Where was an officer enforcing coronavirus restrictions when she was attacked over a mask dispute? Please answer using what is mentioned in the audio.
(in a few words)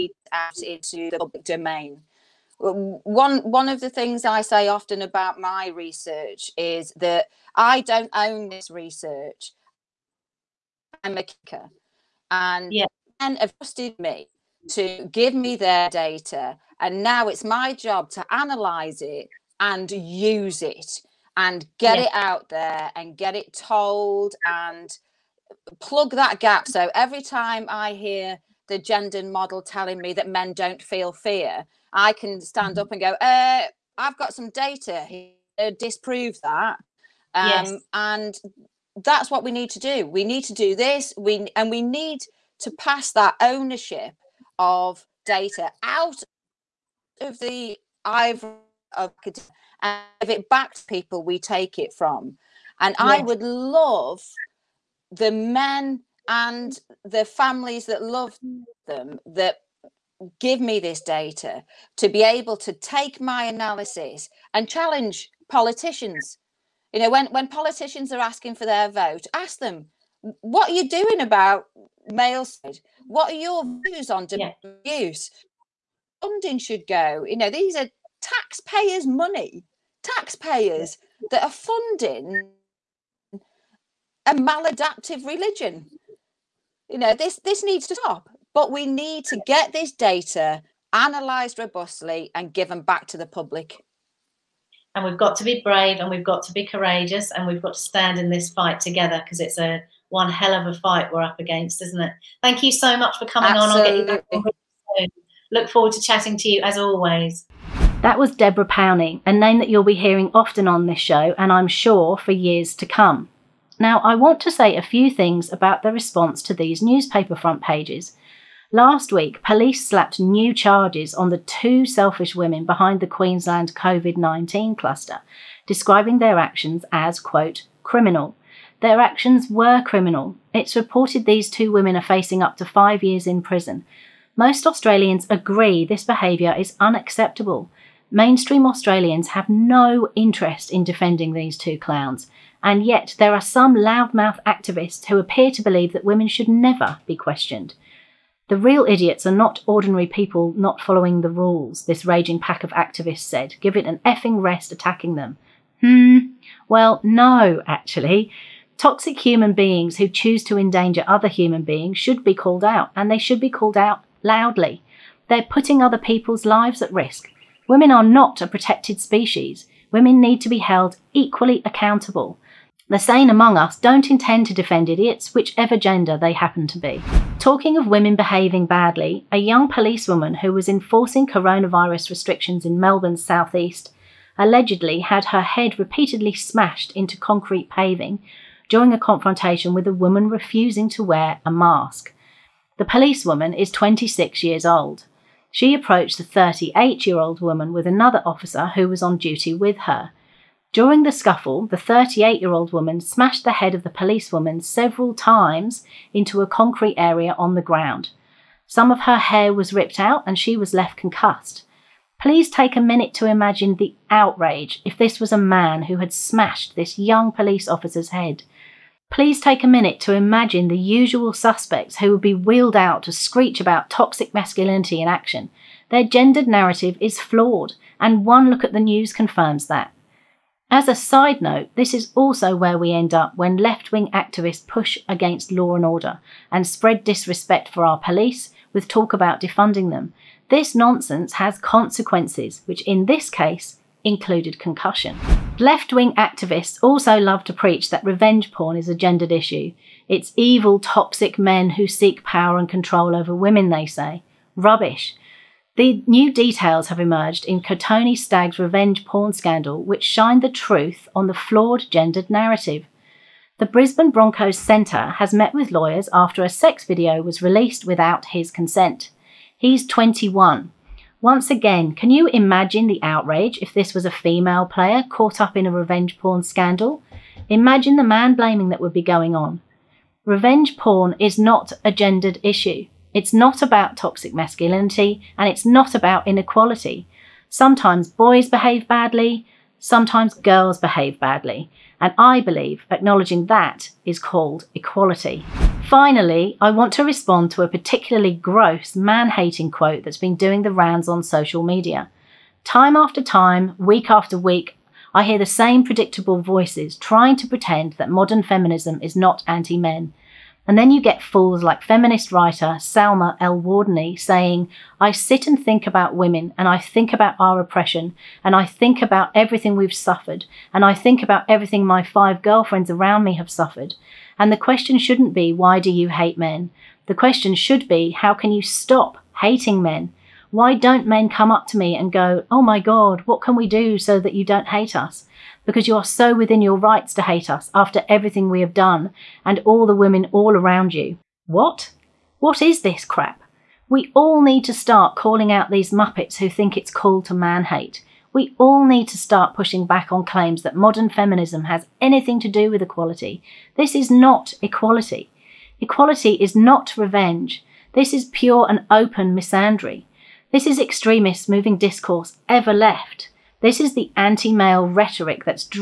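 Melbourne's southeast.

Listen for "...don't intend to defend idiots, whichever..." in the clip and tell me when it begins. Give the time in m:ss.
2:53.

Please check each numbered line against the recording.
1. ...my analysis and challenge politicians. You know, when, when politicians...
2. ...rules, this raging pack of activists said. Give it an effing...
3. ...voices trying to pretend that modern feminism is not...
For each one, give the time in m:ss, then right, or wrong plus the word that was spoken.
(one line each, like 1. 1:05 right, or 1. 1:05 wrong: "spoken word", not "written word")
1. 1:03 right
2. 2:31 right
3. 5:06 right.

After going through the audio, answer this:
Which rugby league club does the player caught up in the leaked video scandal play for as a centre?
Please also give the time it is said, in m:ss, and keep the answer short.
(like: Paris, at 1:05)
Brisbane Broncos, at 4:23.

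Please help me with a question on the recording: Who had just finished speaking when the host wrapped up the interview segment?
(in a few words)
Deborah Powney.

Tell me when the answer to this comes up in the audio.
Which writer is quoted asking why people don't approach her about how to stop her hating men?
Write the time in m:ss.
5:12.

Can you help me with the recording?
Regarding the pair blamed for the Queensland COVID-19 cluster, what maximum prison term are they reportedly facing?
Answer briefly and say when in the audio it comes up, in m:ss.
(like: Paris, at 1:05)
5 years, at 2:12.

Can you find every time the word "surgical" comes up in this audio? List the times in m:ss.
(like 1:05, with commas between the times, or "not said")
not said.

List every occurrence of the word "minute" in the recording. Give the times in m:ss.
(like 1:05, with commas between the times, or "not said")
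3:32, 3:39.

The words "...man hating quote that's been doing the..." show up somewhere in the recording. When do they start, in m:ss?
4:58.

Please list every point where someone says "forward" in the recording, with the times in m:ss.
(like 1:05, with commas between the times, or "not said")
1:45.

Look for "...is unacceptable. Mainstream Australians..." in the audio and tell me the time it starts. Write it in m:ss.
2:16.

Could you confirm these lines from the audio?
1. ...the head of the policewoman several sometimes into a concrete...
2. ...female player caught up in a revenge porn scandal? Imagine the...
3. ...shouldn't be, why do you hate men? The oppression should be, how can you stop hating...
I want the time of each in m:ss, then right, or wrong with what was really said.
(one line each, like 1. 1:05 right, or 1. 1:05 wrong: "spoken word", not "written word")
1. 3:23 wrong: "times", not "sometimes"
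2. 4:34 right
3. 5:24 wrong: "question", not "oppression".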